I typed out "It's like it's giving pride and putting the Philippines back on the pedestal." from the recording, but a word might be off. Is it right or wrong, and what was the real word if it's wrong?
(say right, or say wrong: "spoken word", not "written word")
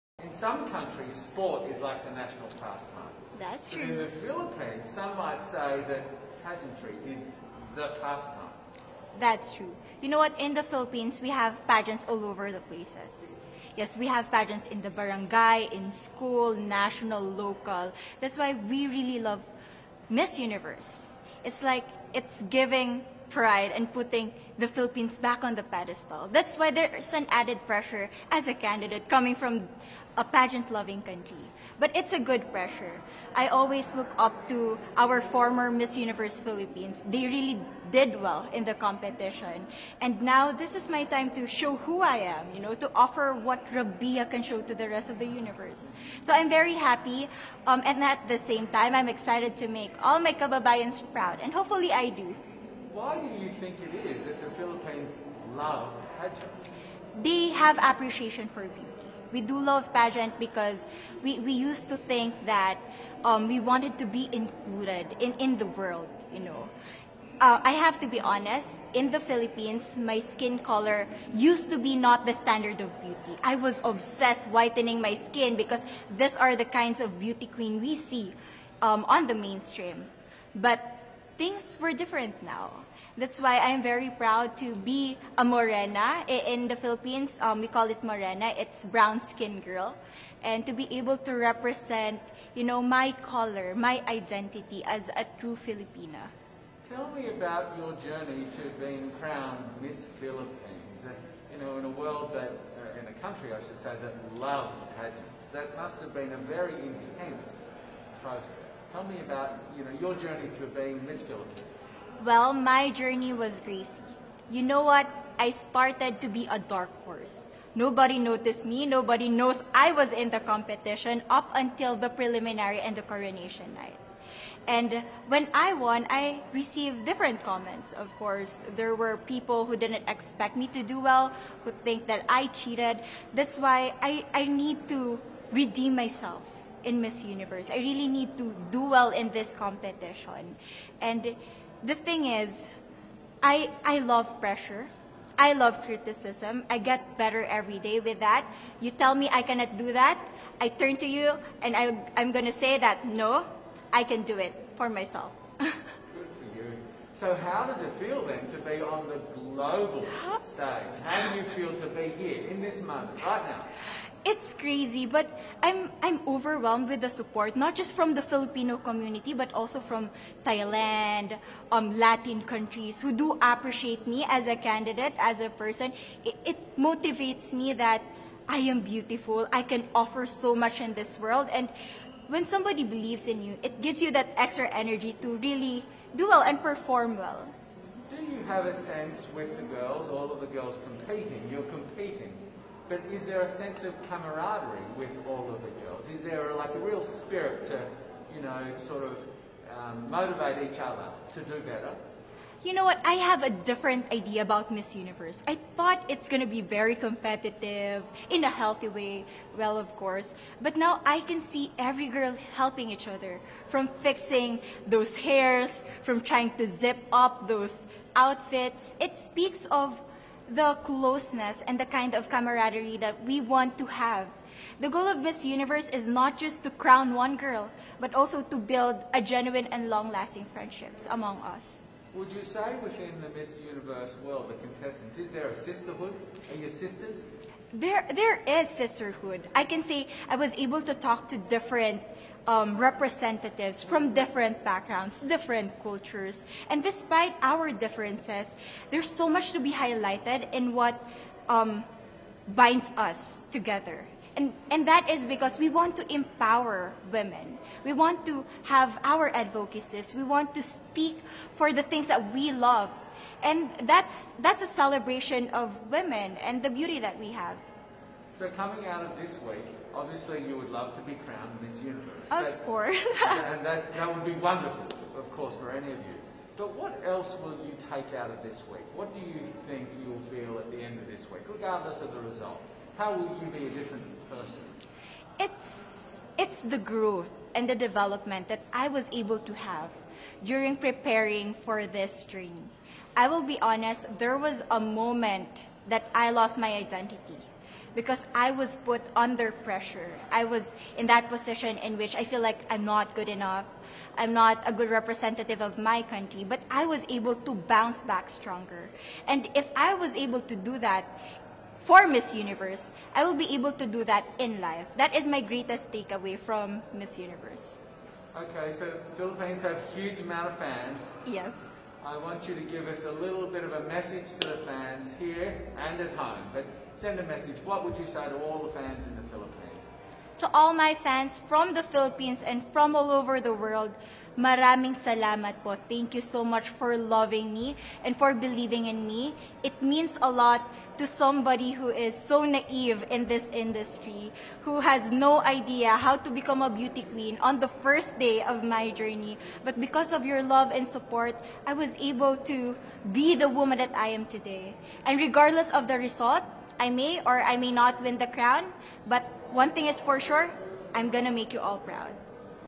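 right.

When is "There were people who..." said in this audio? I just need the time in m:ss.
2:08.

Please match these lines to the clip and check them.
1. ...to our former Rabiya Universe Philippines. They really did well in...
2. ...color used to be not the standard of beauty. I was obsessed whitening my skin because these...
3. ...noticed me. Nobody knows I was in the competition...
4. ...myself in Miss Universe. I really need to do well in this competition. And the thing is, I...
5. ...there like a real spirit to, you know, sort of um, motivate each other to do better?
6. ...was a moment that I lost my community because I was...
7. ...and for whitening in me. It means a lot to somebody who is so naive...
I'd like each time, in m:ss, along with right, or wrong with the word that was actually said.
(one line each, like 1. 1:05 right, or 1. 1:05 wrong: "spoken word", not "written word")
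1. 0:34 wrong: "Miss", not "Rabiya"
2. 1:10 right
3. 1:58 right
4. 2:15 right
5. 3:16 right
6. 4:54 wrong: "identity", not "community"
7. 5:38 wrong: "believing", not "whitening".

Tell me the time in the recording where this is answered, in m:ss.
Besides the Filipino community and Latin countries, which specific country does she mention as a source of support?
2:50.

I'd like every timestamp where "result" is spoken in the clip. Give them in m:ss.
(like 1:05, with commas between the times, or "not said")
4:42, 5:55.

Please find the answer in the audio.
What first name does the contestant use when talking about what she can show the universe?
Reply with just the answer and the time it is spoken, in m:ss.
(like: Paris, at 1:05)
Rabiya, at 0:43.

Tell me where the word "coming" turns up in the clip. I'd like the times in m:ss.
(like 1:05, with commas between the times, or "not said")
0:29, 4:28.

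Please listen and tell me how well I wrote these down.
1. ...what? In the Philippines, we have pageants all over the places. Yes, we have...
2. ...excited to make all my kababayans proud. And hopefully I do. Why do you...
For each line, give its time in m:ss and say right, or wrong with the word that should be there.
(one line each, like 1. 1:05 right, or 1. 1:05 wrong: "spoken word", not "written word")
1. 0:10 right
2. 0:49 right.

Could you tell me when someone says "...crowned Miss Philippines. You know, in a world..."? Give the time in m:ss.
1:39.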